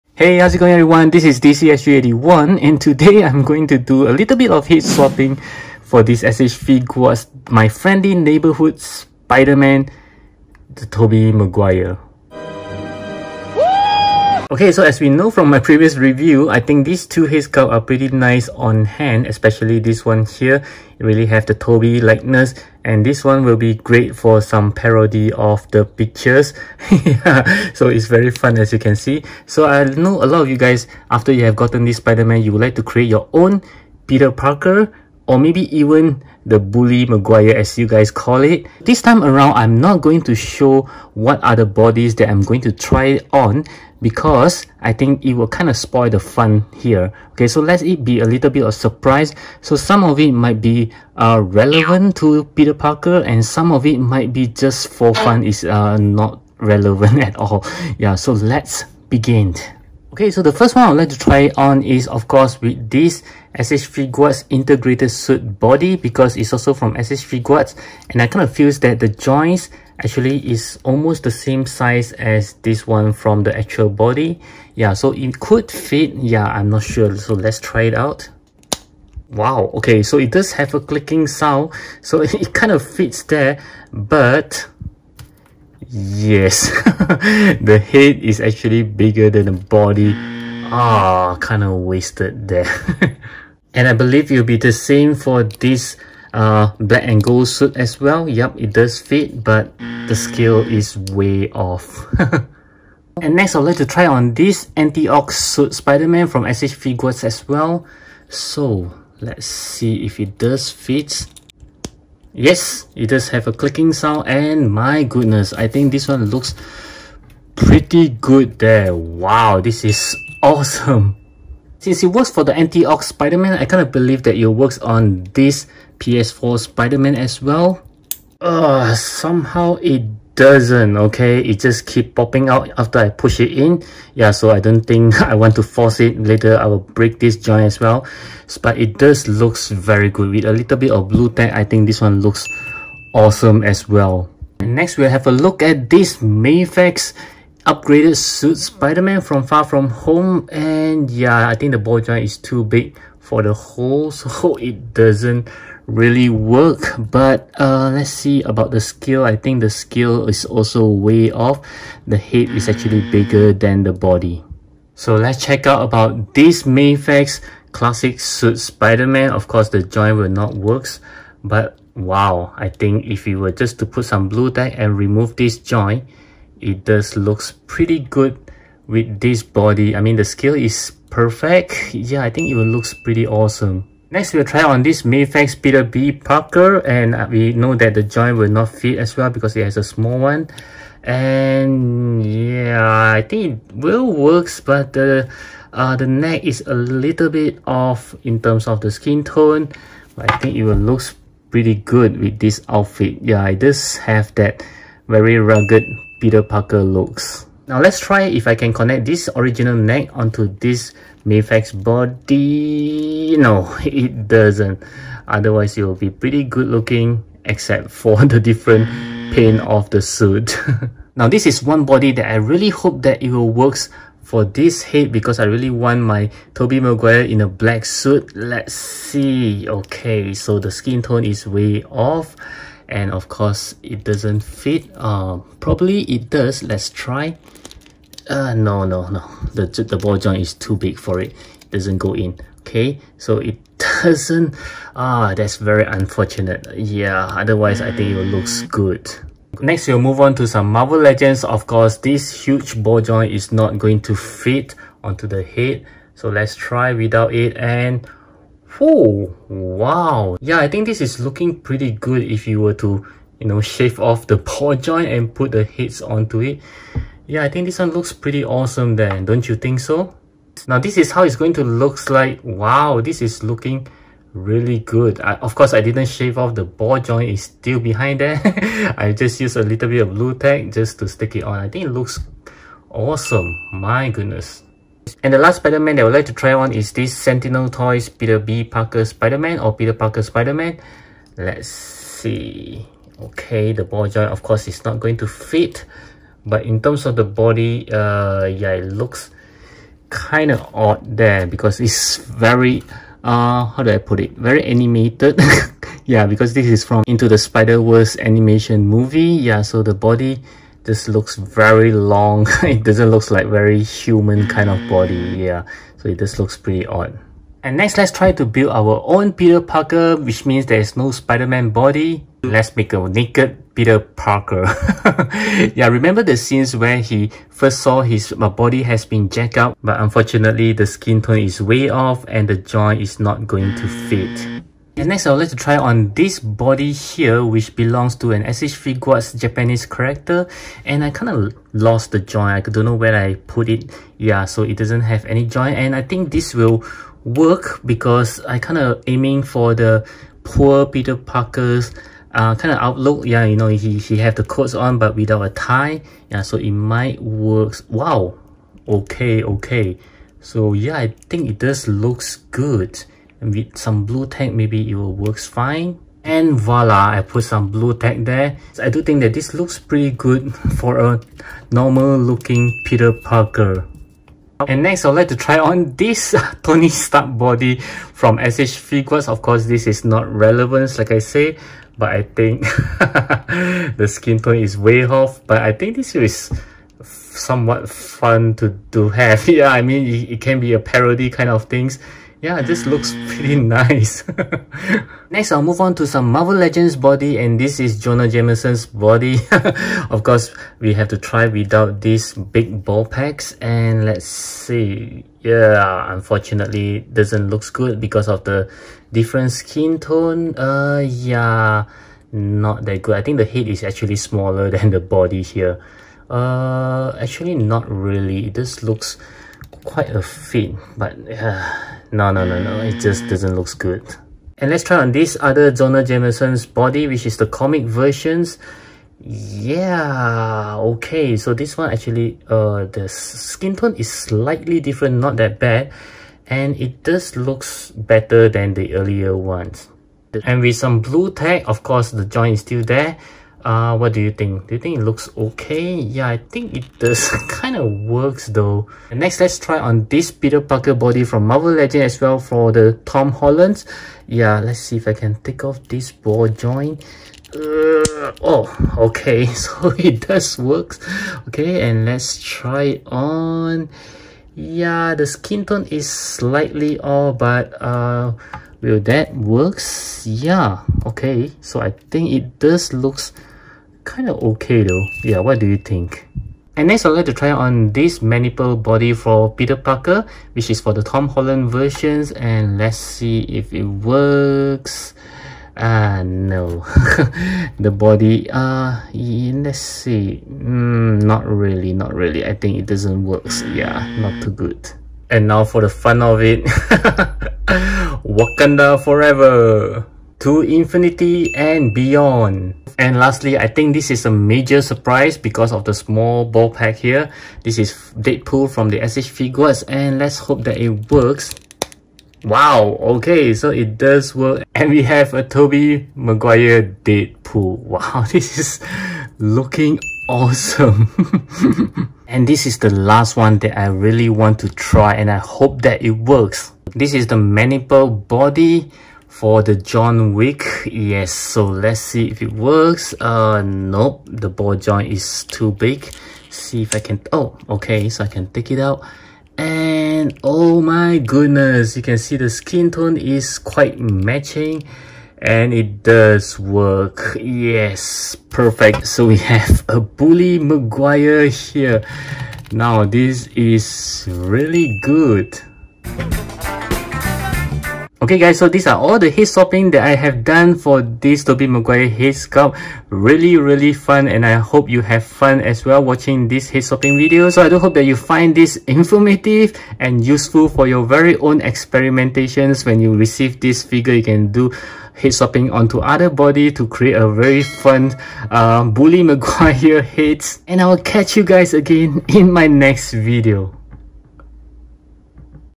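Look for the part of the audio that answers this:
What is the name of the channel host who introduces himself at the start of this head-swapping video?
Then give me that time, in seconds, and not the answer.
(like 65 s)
1 s.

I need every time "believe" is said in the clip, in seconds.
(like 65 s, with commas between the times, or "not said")
93 s, 123 s.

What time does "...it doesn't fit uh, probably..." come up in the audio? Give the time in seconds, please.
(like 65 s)
233 s.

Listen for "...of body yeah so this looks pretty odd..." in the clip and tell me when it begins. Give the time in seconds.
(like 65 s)
314 s.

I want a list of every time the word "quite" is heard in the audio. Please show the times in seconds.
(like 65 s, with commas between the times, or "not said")
419 s, 543 s.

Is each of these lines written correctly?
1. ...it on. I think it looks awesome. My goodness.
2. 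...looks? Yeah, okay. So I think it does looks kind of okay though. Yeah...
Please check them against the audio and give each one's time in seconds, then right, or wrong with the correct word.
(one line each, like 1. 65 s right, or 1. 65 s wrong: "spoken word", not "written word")
1. 281 s right
2. 469 s wrong: "works", not "looks".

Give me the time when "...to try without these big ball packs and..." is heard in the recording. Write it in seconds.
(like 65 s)
401 s.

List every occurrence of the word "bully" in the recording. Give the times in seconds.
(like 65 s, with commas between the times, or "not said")
36 s, 549 s, 578 s.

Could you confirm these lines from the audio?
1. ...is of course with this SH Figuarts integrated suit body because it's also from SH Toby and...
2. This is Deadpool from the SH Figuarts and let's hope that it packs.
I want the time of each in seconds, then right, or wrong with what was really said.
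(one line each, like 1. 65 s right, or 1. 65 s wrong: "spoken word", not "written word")
1. 61 s wrong: "Figuarts", not "Toby"
2. 507 s wrong: "works", not "packs".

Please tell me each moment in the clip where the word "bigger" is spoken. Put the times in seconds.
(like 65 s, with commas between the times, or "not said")
88 s, 163 s.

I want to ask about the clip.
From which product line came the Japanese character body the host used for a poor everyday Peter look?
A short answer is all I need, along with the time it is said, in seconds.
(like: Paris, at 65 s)
SH3, at 338 s.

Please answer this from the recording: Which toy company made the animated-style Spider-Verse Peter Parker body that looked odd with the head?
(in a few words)
Sentinel Toys.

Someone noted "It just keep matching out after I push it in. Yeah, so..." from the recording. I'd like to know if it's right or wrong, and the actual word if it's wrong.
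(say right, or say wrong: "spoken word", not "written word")
wrong: "popping", not "matching".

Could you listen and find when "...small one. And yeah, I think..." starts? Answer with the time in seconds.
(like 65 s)
189 s.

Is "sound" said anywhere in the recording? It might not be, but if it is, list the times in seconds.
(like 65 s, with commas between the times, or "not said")
81 s, 113 s.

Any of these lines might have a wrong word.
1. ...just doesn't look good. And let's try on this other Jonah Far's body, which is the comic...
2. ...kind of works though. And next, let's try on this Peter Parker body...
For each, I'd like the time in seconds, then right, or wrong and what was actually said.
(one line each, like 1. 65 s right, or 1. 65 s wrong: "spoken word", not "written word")
1. 422 s wrong: "Jameson", not "Far"
2. 447 s right.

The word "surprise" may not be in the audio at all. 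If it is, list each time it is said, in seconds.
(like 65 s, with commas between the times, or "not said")
48 s, 504 s.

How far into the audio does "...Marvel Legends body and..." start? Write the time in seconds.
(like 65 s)
396 s.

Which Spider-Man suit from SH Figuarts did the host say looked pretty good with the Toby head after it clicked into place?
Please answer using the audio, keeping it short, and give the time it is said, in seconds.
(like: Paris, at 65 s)
anti-Ock suit, at 104 s.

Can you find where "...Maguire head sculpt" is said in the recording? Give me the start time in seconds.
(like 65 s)
561 s.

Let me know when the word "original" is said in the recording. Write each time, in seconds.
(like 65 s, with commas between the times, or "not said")
209 s.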